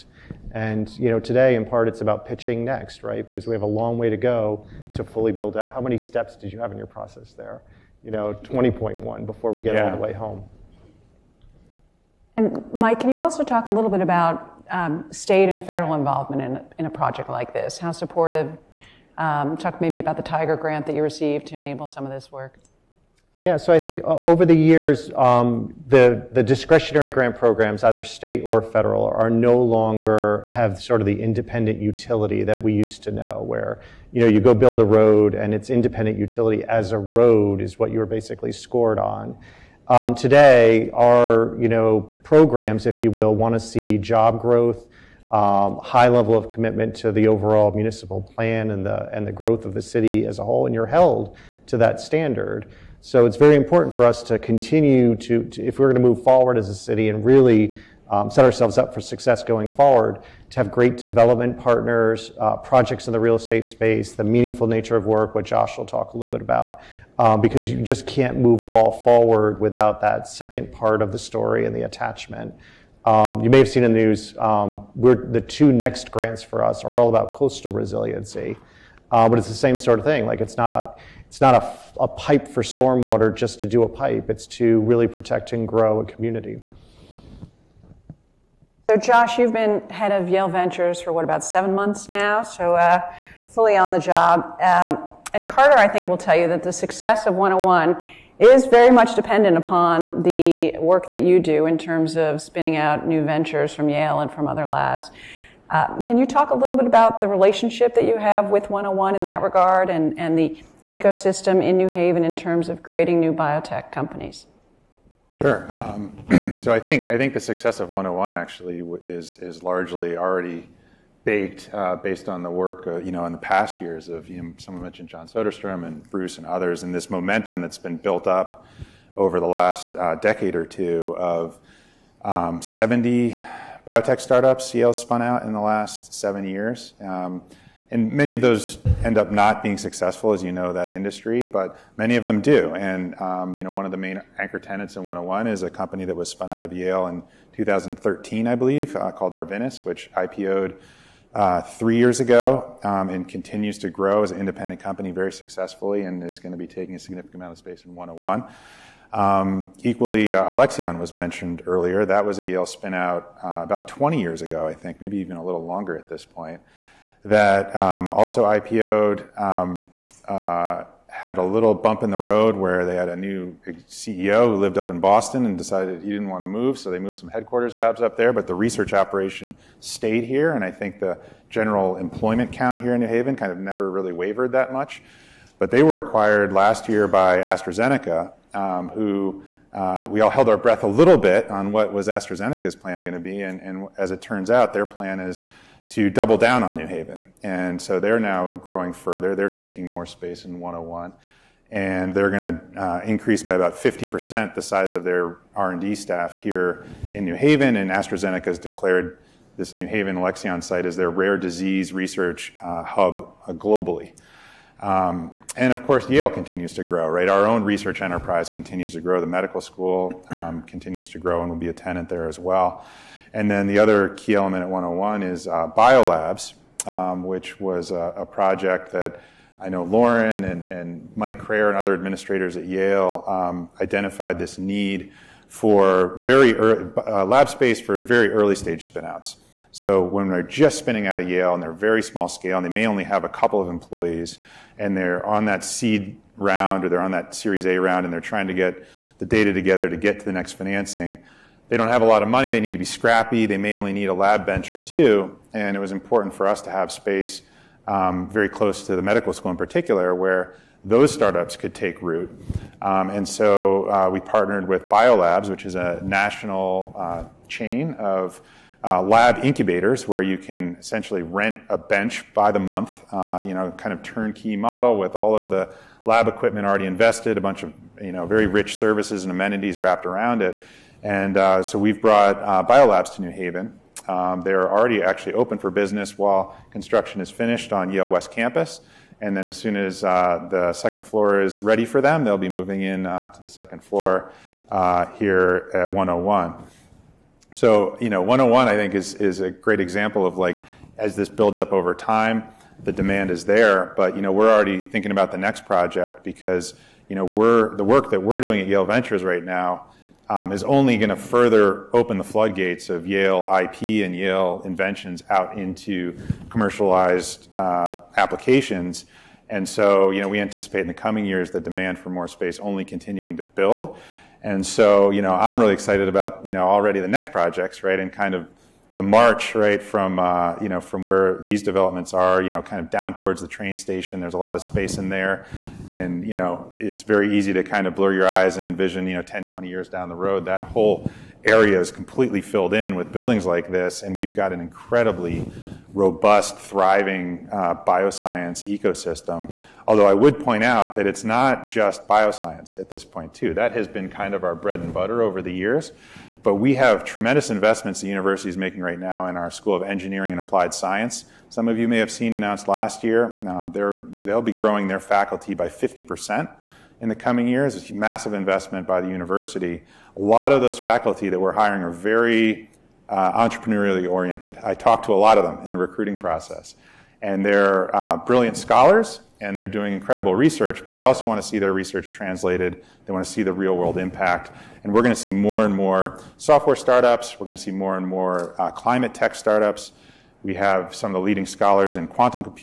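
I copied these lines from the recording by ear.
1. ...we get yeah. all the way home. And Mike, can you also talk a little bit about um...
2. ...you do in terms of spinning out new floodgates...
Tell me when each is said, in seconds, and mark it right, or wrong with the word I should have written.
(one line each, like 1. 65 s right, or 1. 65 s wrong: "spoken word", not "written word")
1. 9 s right
2. 101 s wrong: "ventures", not "floodgates".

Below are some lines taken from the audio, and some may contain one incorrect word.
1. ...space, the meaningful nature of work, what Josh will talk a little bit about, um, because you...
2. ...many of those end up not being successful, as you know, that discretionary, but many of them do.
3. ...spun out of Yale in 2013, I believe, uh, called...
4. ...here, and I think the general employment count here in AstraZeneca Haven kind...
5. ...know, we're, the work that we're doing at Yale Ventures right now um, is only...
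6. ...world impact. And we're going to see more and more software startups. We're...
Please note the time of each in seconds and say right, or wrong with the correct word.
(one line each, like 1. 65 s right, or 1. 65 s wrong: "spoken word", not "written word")
1. 63 s right
2. 138 s wrong: "industry", not "discretionary"
3. 146 s right
4. 180 s wrong: "New", not "AstraZeneca"
5. 307 s right
6. 383 s right.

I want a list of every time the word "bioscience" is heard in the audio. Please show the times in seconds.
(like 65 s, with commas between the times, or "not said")
347 s, 352 s.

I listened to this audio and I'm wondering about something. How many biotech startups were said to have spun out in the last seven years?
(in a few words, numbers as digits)
70.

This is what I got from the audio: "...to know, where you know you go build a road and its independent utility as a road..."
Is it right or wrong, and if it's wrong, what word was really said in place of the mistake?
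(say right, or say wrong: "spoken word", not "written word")
right.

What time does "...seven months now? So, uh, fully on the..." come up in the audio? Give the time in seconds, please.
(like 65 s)
91 s.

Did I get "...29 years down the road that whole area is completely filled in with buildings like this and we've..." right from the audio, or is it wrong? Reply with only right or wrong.
wrong.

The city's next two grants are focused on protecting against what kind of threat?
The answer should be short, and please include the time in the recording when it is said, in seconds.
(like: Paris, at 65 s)
coastal resiliency, at 77 s.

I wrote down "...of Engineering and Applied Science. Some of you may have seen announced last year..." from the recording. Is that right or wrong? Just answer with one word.
right.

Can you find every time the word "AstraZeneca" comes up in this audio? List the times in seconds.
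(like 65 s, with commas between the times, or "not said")
187 s, 192 s, 207 s.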